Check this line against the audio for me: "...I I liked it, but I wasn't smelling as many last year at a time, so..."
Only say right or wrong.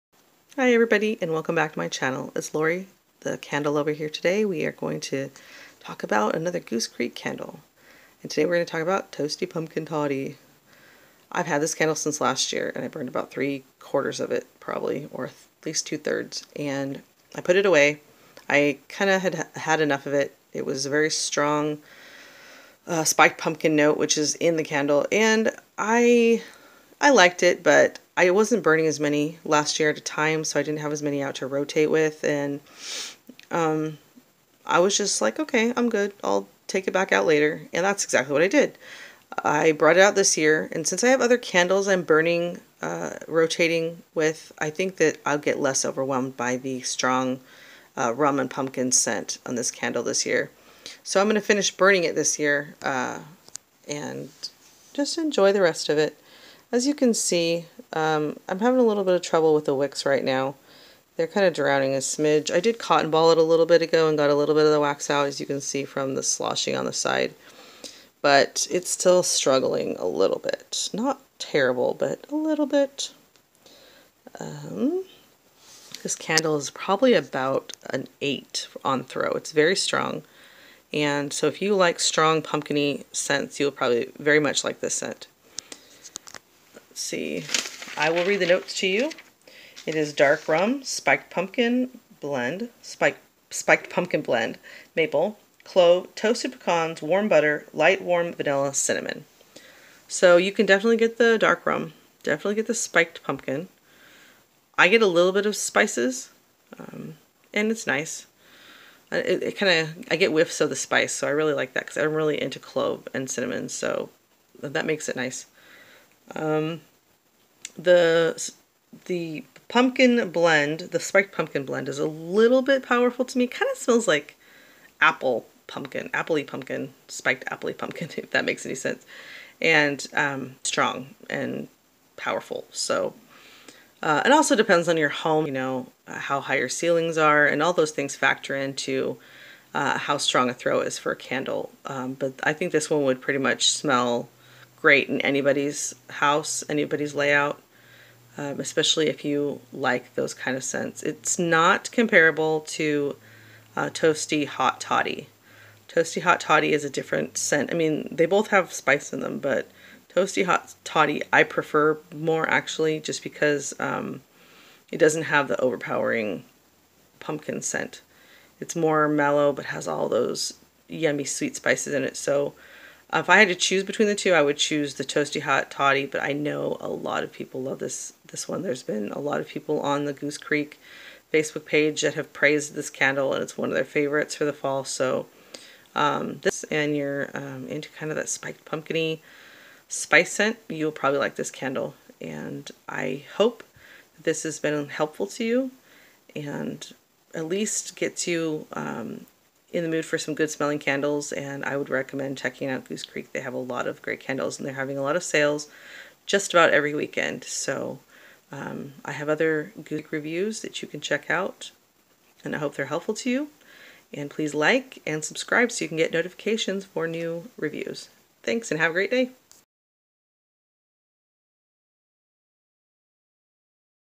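wrong.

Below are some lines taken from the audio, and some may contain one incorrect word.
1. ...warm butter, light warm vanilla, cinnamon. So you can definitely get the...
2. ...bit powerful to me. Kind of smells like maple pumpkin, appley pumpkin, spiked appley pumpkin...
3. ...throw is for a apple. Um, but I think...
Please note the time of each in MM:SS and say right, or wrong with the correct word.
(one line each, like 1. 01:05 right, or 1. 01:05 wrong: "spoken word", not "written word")
1. 01:37 right
2. 02:02 wrong: "apple", not "maple"
3. 02:20 wrong: "candle", not "apple".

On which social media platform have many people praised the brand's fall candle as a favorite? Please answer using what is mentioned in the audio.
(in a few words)
Facebook.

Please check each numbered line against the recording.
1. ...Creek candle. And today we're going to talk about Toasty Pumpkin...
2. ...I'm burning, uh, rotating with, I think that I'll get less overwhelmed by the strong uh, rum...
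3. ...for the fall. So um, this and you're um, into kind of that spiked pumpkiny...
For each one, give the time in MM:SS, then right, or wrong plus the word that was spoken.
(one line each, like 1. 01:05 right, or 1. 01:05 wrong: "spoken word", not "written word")
1. 00:06 right
2. 00:41 right
3. 03:04 right.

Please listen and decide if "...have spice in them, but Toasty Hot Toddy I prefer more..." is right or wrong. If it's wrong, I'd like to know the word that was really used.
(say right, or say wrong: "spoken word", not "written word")
right.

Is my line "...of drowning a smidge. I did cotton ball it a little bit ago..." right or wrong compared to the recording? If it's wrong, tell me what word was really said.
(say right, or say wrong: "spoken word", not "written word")
right.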